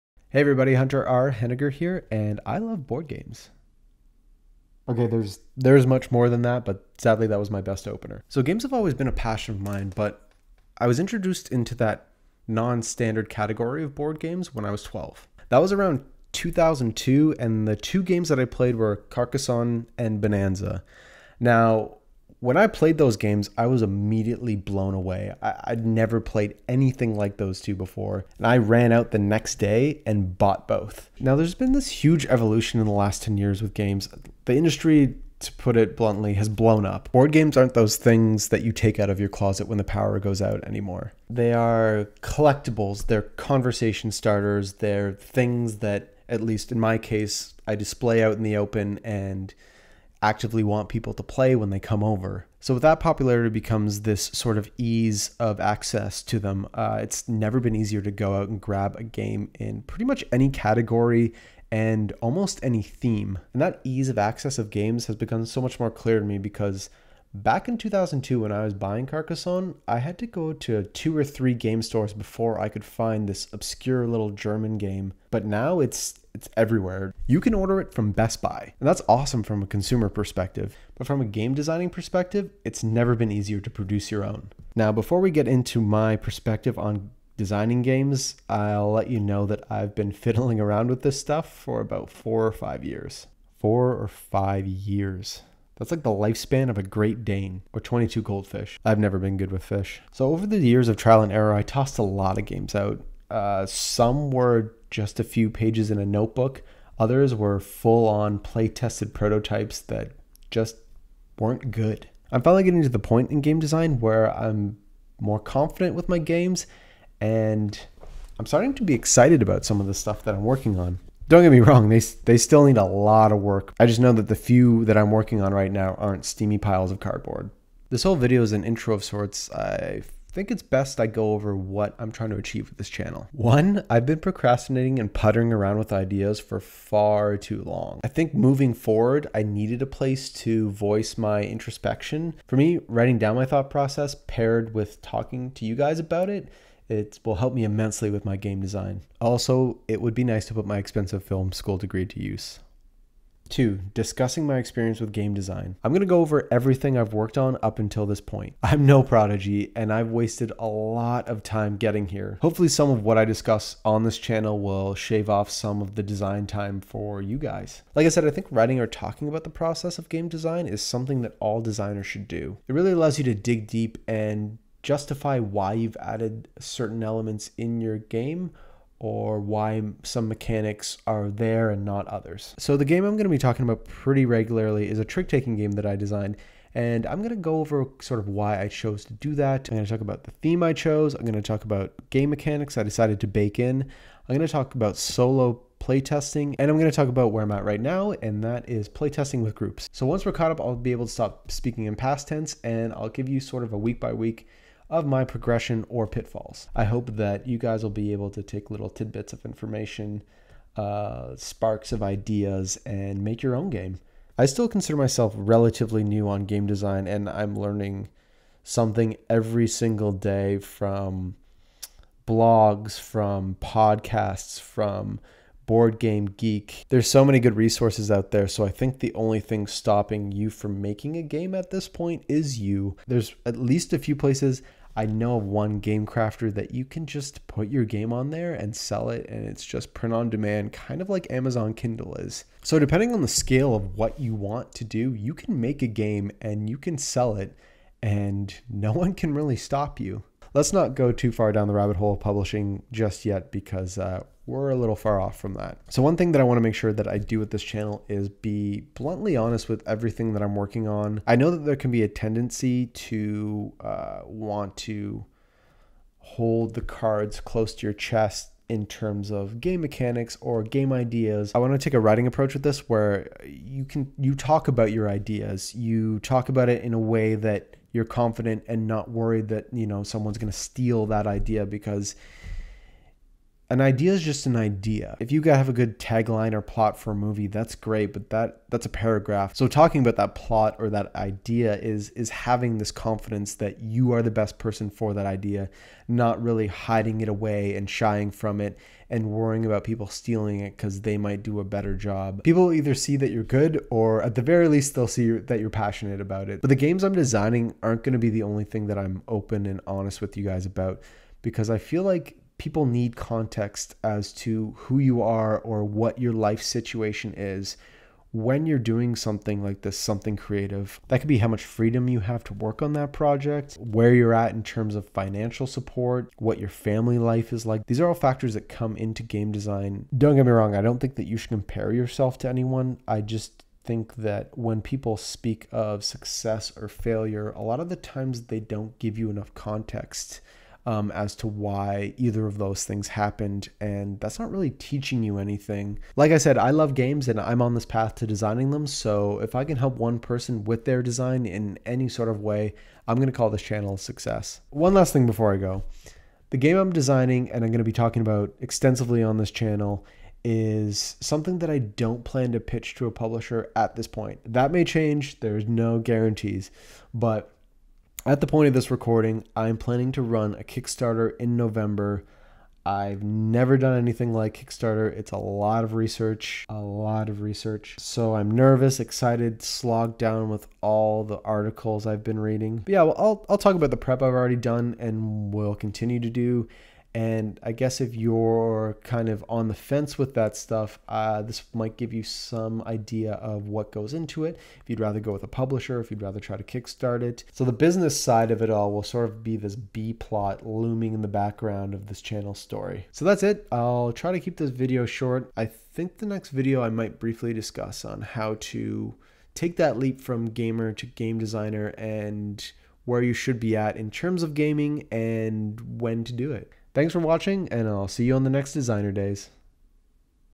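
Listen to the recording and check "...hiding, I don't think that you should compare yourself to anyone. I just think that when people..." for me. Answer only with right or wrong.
wrong.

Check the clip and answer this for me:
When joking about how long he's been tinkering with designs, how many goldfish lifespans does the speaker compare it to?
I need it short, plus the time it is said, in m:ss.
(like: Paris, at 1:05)
22, at 1:37.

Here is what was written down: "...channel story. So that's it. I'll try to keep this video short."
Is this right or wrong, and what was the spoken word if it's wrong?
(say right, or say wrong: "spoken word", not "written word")
right.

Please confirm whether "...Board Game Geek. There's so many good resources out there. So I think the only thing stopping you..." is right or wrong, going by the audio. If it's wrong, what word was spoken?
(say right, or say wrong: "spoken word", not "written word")
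right.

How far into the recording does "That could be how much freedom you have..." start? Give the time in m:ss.
5:21.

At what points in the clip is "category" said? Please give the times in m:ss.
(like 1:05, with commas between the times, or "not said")
0:13, 1:00.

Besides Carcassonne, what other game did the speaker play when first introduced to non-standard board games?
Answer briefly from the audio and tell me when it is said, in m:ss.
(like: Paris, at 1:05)
Bonanza, at 0:20.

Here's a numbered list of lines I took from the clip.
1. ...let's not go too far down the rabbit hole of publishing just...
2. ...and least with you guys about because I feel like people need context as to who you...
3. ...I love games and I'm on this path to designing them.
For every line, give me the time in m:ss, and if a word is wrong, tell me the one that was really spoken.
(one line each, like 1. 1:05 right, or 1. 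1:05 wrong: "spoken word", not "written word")
1. 4:10 right
2. 5:09 wrong: "honest", not "least"
3. 5:46 right.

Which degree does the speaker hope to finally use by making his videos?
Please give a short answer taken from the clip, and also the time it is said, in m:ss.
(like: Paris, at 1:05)
film school degree, at 2:31.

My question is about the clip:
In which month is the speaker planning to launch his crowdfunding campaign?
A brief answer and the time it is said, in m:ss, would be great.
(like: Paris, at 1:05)
November, at 6:11.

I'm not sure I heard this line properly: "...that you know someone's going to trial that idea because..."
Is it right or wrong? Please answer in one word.
wrong.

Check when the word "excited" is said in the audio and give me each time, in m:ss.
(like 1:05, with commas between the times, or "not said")
1:58, 6:18.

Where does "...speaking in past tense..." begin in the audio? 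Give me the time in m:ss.
3:21.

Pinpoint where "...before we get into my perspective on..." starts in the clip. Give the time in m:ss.
1:24.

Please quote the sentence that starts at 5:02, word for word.
People either see that you're good or at the very least they'll see that you're passionate about it.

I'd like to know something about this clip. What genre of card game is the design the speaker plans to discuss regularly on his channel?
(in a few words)
trick-taking game.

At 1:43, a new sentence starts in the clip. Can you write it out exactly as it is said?
Uh, some were just a few pages in a notebook.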